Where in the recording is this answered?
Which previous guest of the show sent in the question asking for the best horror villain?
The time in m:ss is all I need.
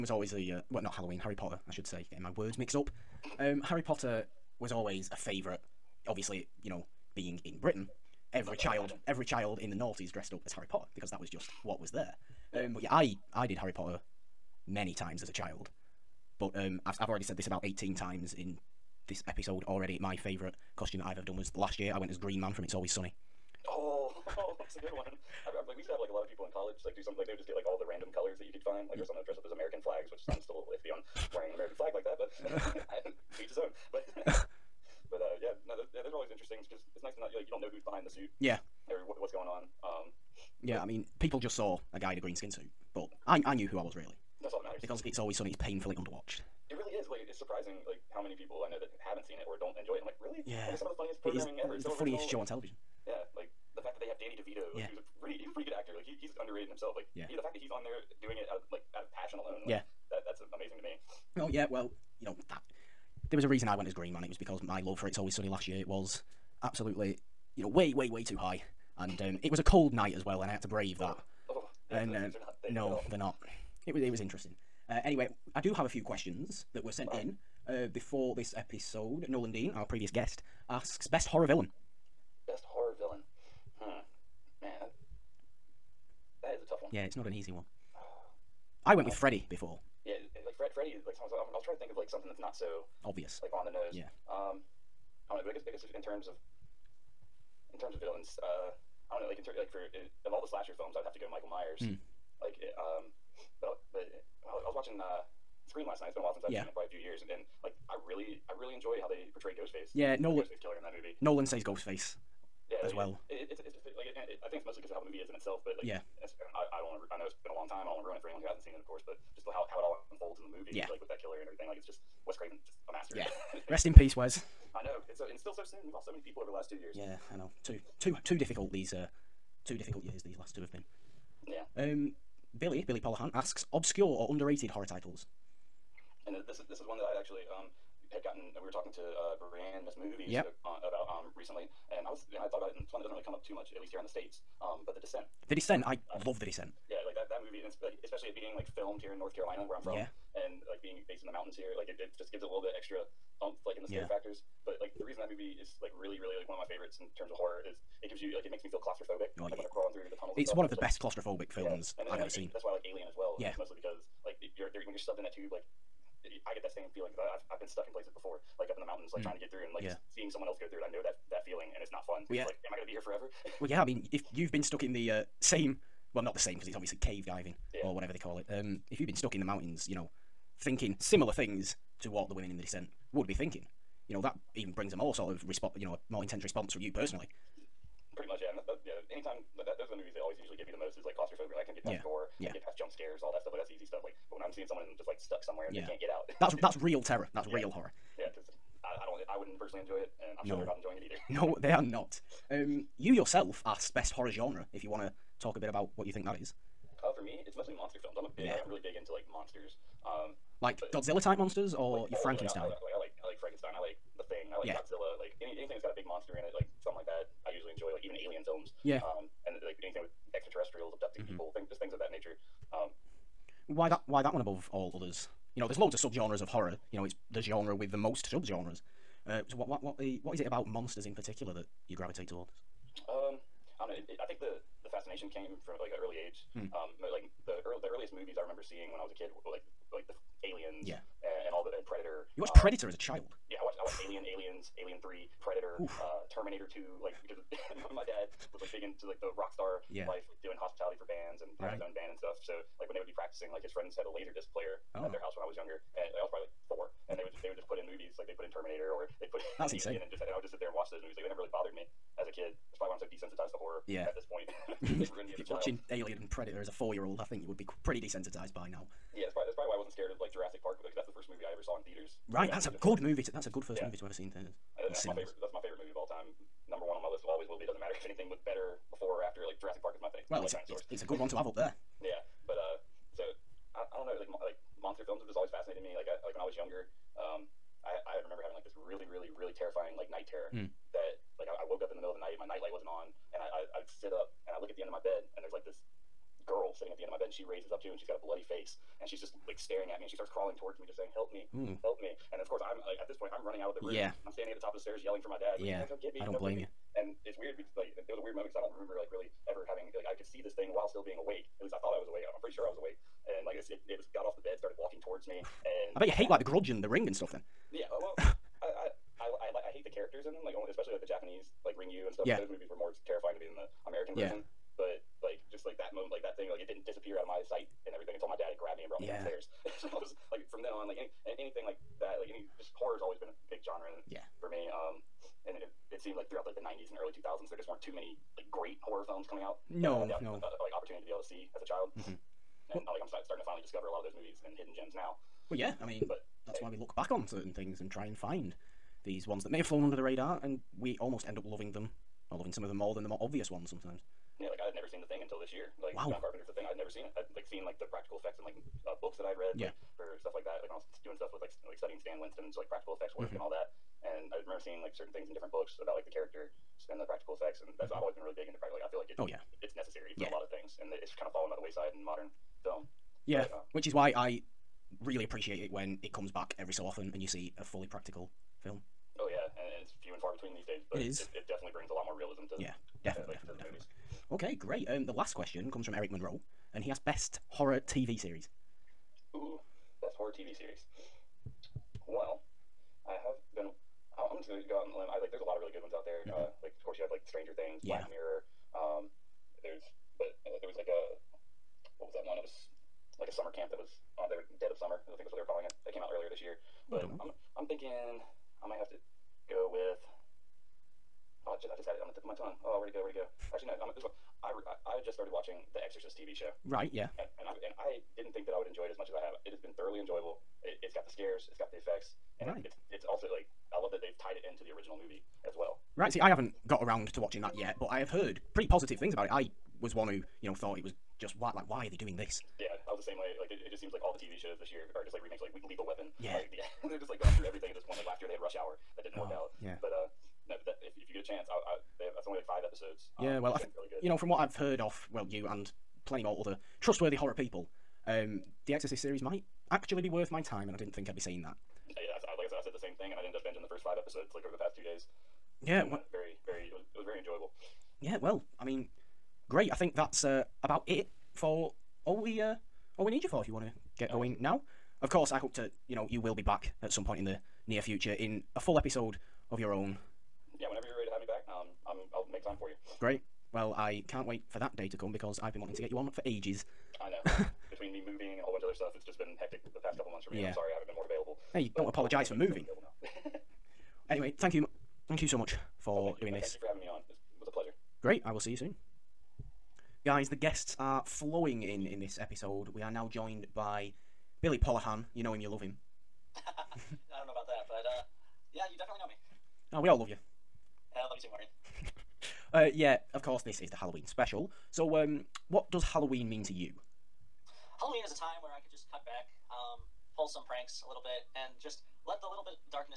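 1:19.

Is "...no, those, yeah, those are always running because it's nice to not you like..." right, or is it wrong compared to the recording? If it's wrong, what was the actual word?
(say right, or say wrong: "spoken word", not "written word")
wrong: "interesting", not "running".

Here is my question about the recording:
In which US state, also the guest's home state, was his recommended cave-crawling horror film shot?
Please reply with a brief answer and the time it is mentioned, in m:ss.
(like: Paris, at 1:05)
North Carolina, at 2:29.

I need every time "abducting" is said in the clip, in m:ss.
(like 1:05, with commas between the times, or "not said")
3:40.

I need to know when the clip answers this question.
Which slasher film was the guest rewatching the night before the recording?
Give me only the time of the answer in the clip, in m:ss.
1:45.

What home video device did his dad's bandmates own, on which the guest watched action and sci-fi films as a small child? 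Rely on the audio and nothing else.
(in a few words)
Laser disc player.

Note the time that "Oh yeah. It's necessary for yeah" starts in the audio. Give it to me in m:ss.
6:09.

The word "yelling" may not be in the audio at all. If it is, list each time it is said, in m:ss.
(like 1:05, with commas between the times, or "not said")
5:05.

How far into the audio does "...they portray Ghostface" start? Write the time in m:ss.
1:49.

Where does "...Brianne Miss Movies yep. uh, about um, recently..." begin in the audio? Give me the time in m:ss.
2:19.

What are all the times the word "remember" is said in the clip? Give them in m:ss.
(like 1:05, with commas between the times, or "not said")
3:58, 4:48, 5:08, 6:04.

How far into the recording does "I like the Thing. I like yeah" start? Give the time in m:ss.
3:33.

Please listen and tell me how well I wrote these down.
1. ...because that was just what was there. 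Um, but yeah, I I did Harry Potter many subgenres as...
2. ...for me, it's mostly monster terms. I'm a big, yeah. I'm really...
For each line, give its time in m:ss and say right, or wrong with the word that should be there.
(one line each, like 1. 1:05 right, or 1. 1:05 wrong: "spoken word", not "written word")
1. 0:10 wrong: "times", not "subgenres"
2. 3:27 wrong: "films", not "terms".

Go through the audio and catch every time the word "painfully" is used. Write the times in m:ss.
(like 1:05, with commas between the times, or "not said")
0:45.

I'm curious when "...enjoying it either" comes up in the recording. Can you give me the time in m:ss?
3:20.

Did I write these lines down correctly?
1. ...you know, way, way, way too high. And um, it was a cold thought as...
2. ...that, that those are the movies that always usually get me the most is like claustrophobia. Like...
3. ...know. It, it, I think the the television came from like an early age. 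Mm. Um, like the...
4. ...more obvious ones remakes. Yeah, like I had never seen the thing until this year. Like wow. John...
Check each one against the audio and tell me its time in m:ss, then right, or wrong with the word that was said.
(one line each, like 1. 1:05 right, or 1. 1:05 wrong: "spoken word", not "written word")
1. 1:07 wrong: "night", not "thought"
2. 3:09 right
3. 3:53 wrong: "fascination", not "television"
4. 5:53 wrong: "sometimes", not "remakes".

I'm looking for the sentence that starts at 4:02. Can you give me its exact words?
You watched um, Predator as a child.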